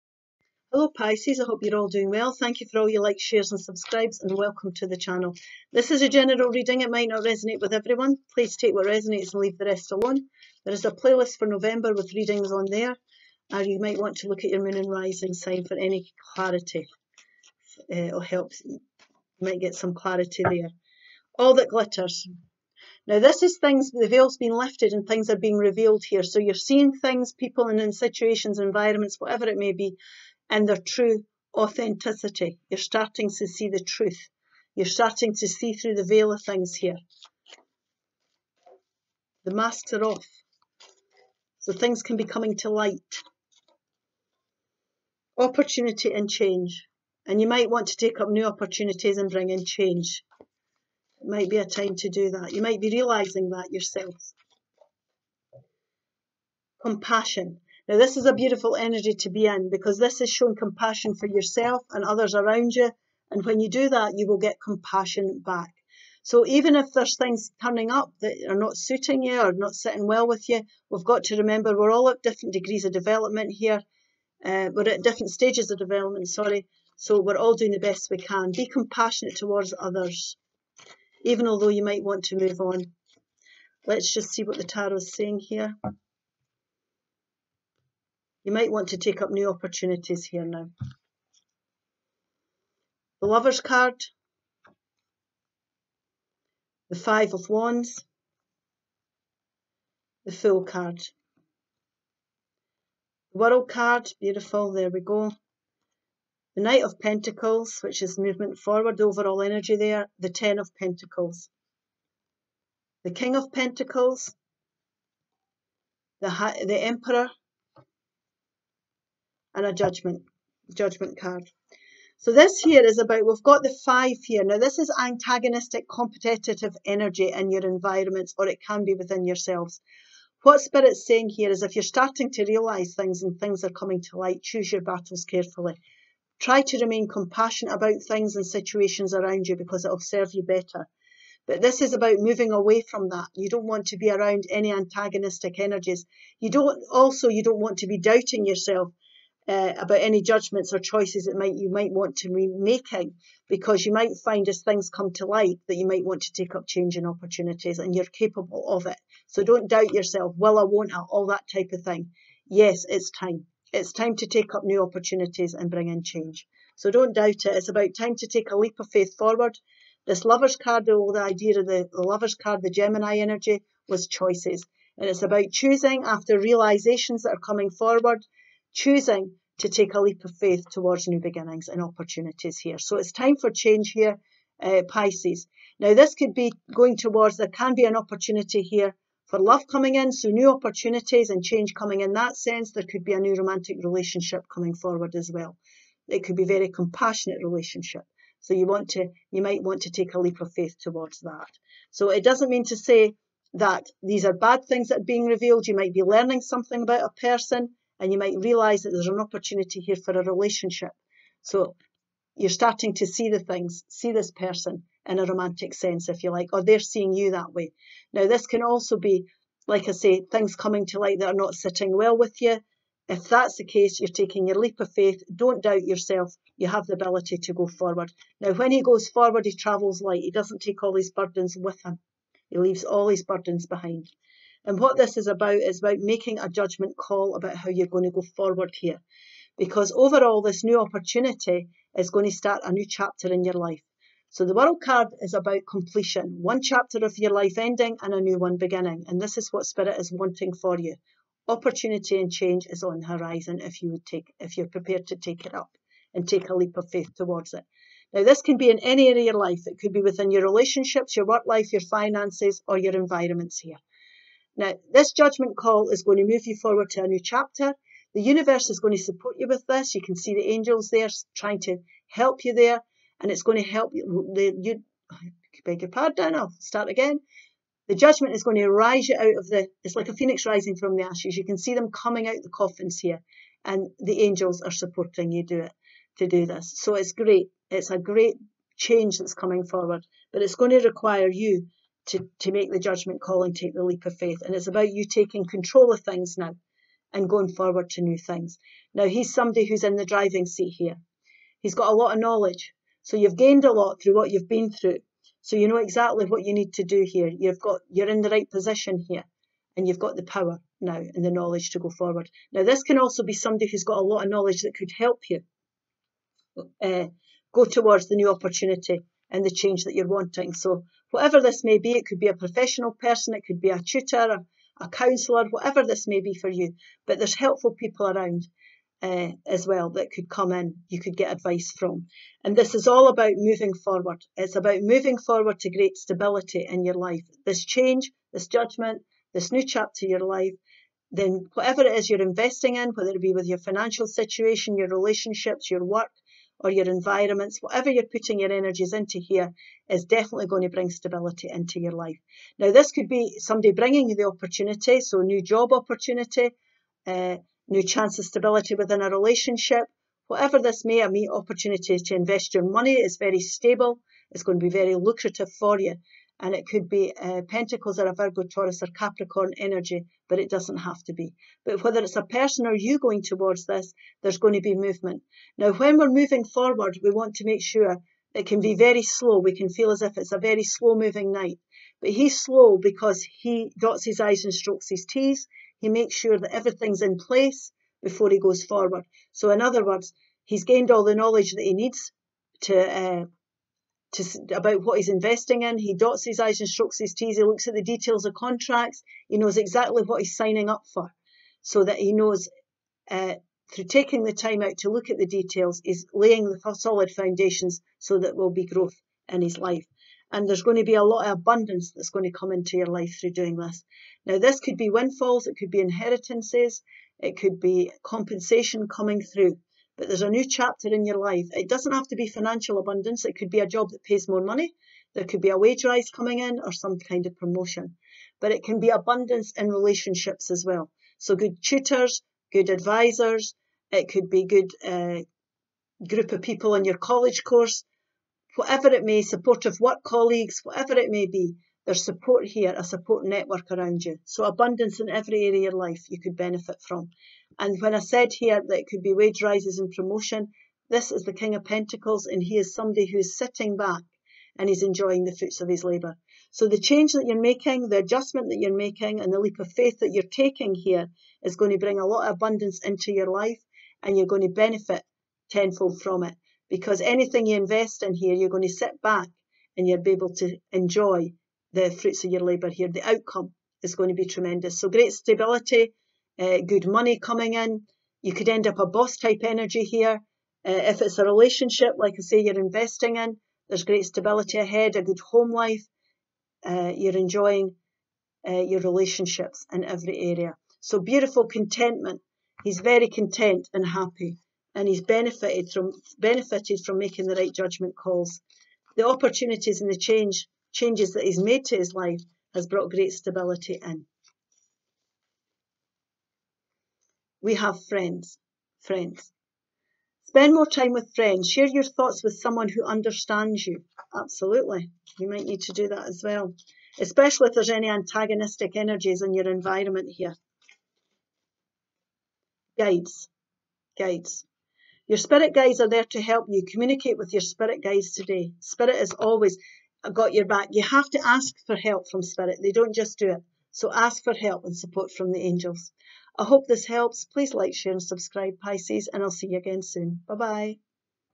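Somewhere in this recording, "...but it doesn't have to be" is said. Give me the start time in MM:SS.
06:10.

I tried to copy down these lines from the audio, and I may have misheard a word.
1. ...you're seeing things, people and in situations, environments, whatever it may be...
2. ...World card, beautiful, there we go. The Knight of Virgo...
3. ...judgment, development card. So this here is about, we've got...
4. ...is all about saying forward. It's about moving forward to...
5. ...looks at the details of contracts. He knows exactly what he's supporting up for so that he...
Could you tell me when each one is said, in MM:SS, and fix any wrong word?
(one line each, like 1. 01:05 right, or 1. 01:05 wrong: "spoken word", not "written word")
1. 00:26 right
2. 01:43 wrong: "Pentacles", not "Virgo"
3. 01:59 wrong: "judgment", not "development"
4. 05:32 wrong: "moving", not "saying"
5. 06:37 wrong: "signing", not "supporting".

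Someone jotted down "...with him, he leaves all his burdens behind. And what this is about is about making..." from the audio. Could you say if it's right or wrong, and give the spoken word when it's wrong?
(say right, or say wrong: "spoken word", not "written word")
right.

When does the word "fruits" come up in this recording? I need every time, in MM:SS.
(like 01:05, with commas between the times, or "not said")
07:35, 07:51.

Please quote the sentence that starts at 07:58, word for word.
You could end up a boss type energy here.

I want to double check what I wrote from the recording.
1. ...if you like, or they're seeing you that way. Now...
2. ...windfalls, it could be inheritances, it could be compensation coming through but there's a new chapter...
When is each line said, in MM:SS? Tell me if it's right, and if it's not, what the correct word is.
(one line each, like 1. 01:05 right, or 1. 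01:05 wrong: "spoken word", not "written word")
1. 03:36 right
2. 06:54 right.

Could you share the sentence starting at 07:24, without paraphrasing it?
So abundance in every area of life you could benefit from.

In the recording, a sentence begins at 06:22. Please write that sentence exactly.
But he's slow because he dots his I's and strokes his T's.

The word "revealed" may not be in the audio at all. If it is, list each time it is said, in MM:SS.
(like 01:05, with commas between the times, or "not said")
00:25, 03:25.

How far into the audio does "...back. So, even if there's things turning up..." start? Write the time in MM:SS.
01:05.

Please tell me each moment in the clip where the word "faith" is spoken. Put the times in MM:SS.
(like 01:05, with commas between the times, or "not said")
02:48, 03:00, 03:20, 03:44, 04:16, 04:54, 07:39.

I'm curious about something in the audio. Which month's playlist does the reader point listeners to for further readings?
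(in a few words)
November.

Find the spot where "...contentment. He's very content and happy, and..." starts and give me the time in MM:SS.
08:11.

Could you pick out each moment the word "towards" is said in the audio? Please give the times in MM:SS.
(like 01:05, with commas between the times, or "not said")
01:19, 03:00, 03:06, 03:20, 04:17, 05:17, 06:13.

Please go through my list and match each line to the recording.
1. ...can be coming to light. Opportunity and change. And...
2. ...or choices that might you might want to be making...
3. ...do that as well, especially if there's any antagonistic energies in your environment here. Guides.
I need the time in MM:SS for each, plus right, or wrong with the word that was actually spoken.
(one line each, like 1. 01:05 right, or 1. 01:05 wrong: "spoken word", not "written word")
1. 00:42 right
2. 02:30 right
3. 08:35 right.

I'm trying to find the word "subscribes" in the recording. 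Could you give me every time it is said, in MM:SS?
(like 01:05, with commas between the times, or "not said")
00:03, 08:58.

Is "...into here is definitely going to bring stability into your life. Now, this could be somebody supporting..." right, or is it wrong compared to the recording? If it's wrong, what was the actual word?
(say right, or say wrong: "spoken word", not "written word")
wrong: "bringing", not "supporting".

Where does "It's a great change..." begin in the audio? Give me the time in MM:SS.
04:47.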